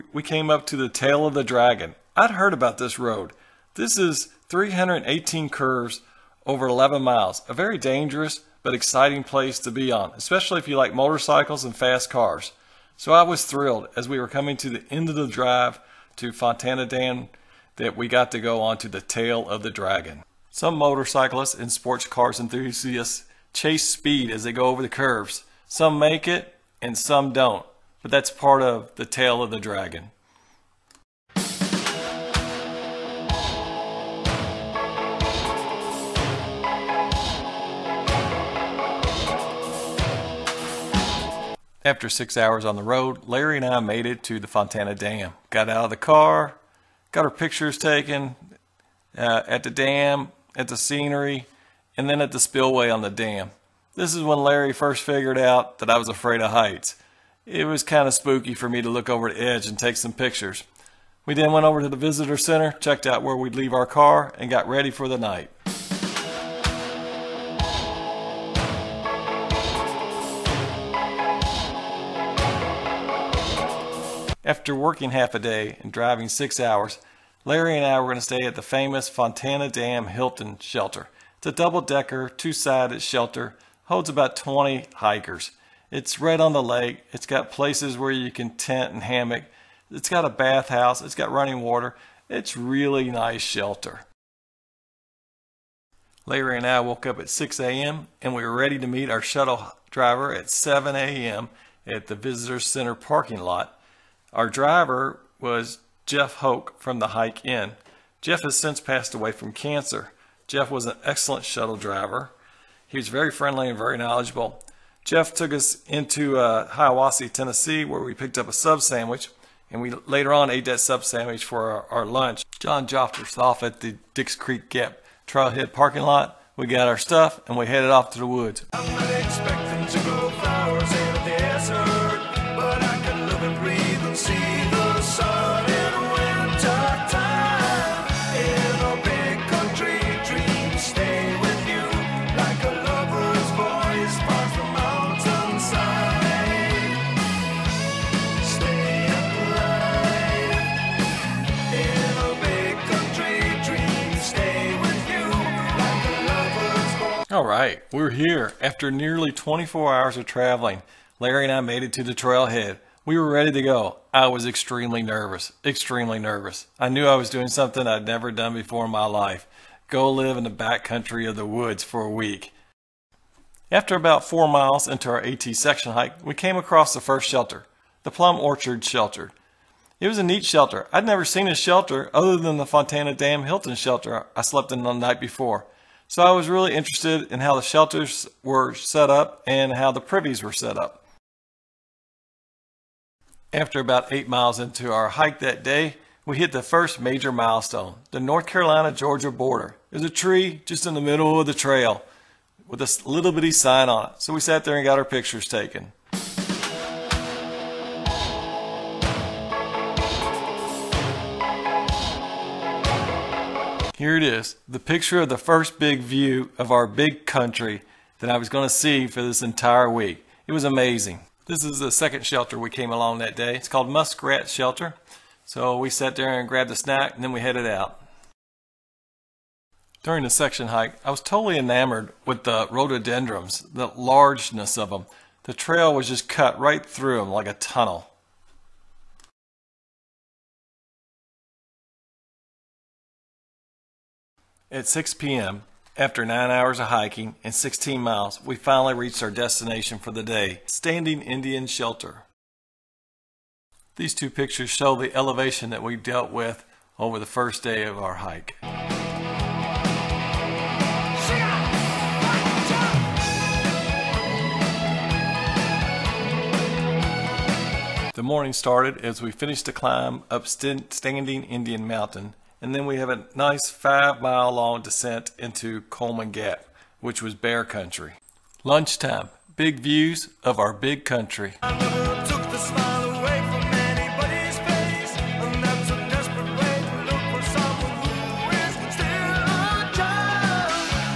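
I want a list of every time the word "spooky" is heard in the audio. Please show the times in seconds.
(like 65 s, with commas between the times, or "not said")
58 s.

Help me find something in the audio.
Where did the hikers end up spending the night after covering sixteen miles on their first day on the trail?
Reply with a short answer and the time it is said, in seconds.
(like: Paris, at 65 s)
Standing Indian Shelter, at 250 s.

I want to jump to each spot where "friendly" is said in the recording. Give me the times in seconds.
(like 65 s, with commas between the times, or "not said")
113 s.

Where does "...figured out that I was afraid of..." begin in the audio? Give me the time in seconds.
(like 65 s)
55 s.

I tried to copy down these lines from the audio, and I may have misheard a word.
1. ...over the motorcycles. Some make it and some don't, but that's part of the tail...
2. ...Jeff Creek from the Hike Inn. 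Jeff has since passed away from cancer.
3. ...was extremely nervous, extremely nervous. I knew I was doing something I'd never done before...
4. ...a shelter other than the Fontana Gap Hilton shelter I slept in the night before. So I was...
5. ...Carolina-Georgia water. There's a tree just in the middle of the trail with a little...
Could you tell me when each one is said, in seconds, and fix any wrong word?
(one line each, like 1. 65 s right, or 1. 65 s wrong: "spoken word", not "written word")
1. 24 s wrong: "curves", not "motorcycles"
2. 106 s wrong: "Hoke", not "Creek"
3. 164 s right
4. 181 s wrong: "Dam", not "Gap"
5. 198 s wrong: "border", not "water".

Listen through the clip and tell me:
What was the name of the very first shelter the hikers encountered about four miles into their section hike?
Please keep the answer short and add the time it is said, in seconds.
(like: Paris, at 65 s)
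Plum Orchard Shelter, at 178 s.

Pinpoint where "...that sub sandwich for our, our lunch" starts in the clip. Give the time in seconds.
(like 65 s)
120 s.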